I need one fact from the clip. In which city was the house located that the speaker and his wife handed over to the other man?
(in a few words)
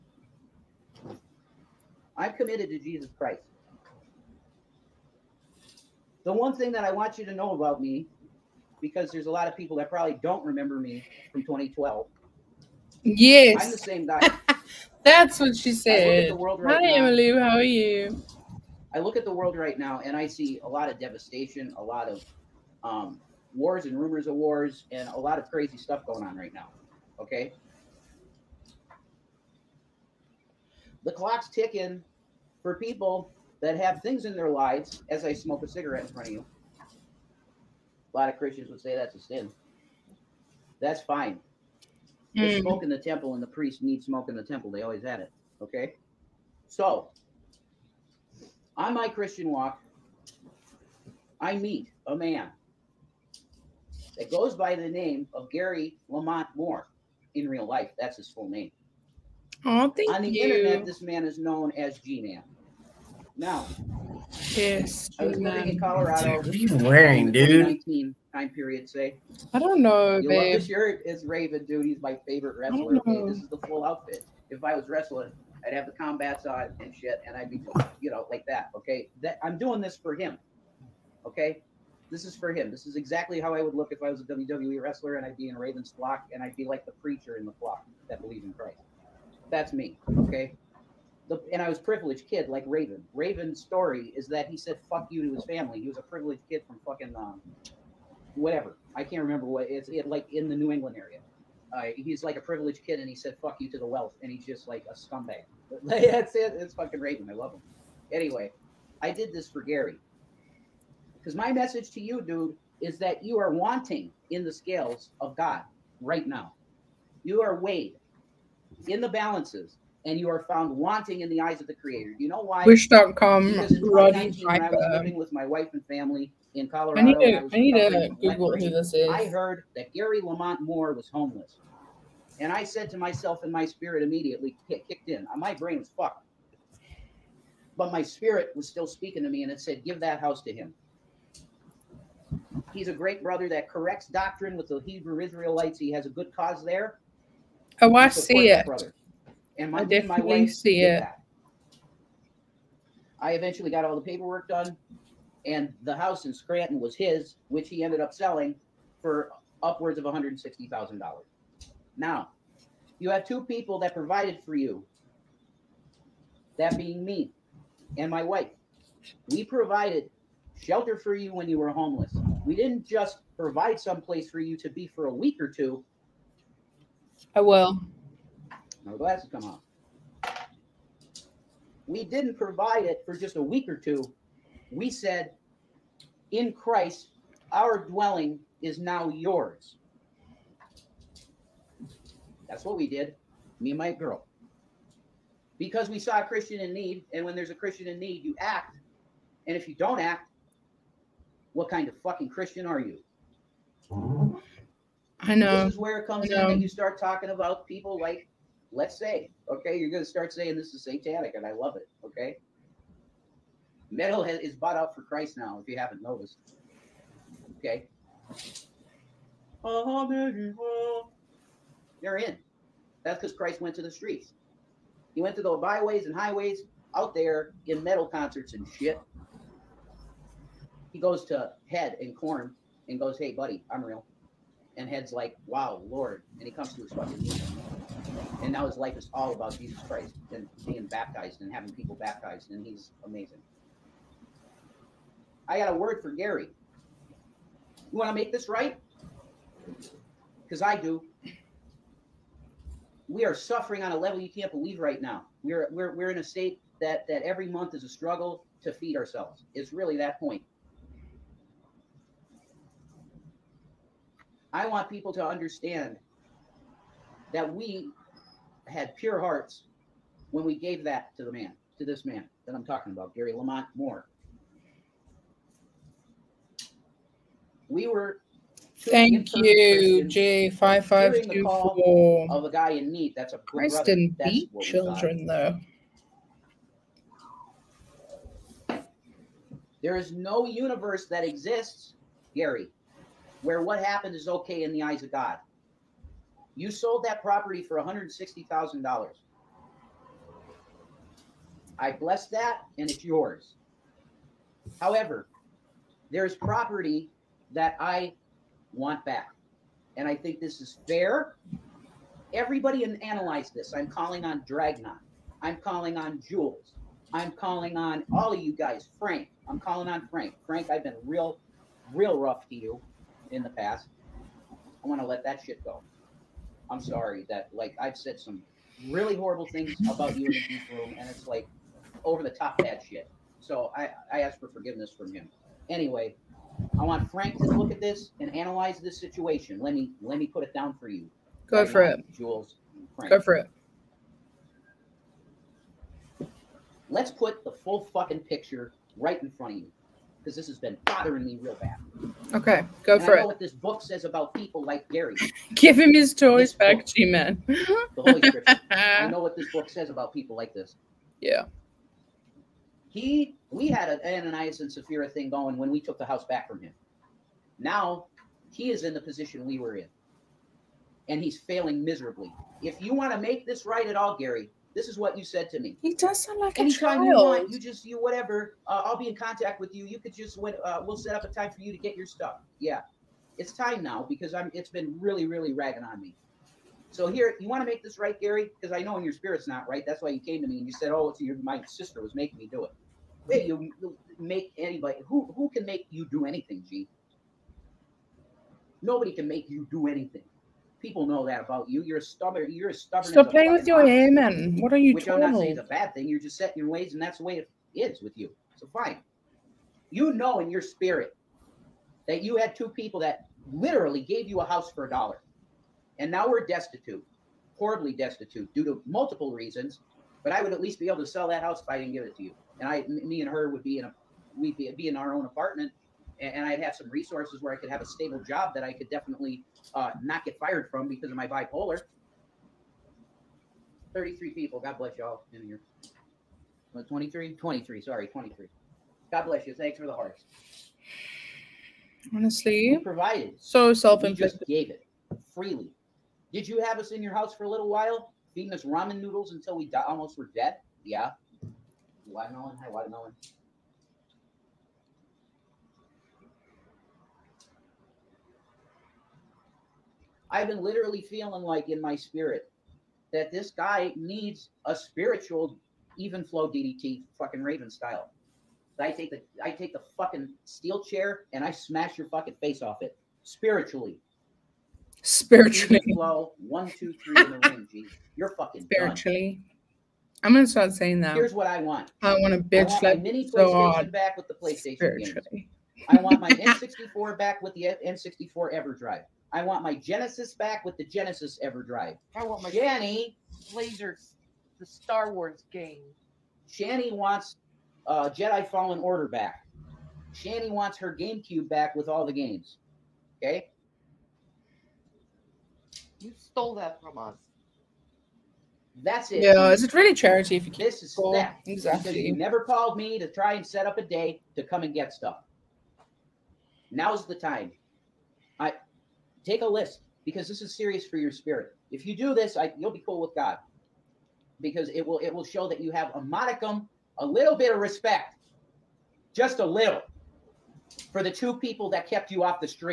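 Scranton.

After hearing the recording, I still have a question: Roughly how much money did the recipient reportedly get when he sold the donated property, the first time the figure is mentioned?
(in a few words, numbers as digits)
$160,000.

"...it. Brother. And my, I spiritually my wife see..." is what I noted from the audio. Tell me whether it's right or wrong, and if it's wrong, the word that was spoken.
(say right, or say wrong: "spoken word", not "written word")
wrong: "definitely", not "spiritually".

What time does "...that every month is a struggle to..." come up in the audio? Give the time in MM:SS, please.
04:17.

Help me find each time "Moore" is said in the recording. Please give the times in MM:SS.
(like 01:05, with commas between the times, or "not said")
00:56, 02:10, 04:33.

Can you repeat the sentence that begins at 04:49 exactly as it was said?
There is no universe that exists, Gary, where what happened is okay in the eyes of God.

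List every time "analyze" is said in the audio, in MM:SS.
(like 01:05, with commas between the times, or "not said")
05:13, 05:38.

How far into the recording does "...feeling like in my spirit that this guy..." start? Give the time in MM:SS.
07:41.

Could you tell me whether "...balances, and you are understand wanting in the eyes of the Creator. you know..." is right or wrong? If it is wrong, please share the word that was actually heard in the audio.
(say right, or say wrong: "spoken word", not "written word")
wrong: "found", not "understand".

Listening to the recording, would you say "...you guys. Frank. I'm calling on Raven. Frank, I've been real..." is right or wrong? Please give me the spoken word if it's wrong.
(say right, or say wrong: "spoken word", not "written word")
wrong: "Frank", not "Raven".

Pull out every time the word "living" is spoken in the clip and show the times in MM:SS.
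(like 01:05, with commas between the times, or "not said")
01:05, 02:04.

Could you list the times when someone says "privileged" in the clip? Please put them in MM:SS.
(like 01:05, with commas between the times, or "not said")
01:31, 01:36, 01:42.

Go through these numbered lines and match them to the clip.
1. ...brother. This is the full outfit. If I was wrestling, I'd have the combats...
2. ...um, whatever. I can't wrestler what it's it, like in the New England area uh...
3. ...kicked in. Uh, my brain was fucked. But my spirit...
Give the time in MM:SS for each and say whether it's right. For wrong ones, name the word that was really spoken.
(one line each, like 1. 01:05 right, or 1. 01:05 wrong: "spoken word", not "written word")
1. 01:12 wrong: "wrestler", not "brother"
2. 01:37 wrong: "remember", not "wrestler"
3. 02:14 right.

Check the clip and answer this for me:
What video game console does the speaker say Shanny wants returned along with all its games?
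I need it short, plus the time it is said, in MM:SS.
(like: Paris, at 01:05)
GameCube, at 08:20.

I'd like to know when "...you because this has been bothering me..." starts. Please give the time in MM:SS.
05:49.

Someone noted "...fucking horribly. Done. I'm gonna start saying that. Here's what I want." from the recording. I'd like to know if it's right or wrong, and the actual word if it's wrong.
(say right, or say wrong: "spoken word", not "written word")
wrong: "spiritually", not "horribly".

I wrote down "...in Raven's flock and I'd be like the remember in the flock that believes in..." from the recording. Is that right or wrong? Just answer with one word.
wrong.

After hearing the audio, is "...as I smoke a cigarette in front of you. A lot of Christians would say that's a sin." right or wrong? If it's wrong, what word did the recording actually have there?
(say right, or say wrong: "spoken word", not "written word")
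right.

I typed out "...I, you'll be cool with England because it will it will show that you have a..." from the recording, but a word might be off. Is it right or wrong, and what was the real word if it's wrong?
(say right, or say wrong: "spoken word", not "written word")
wrong: "God", not "England".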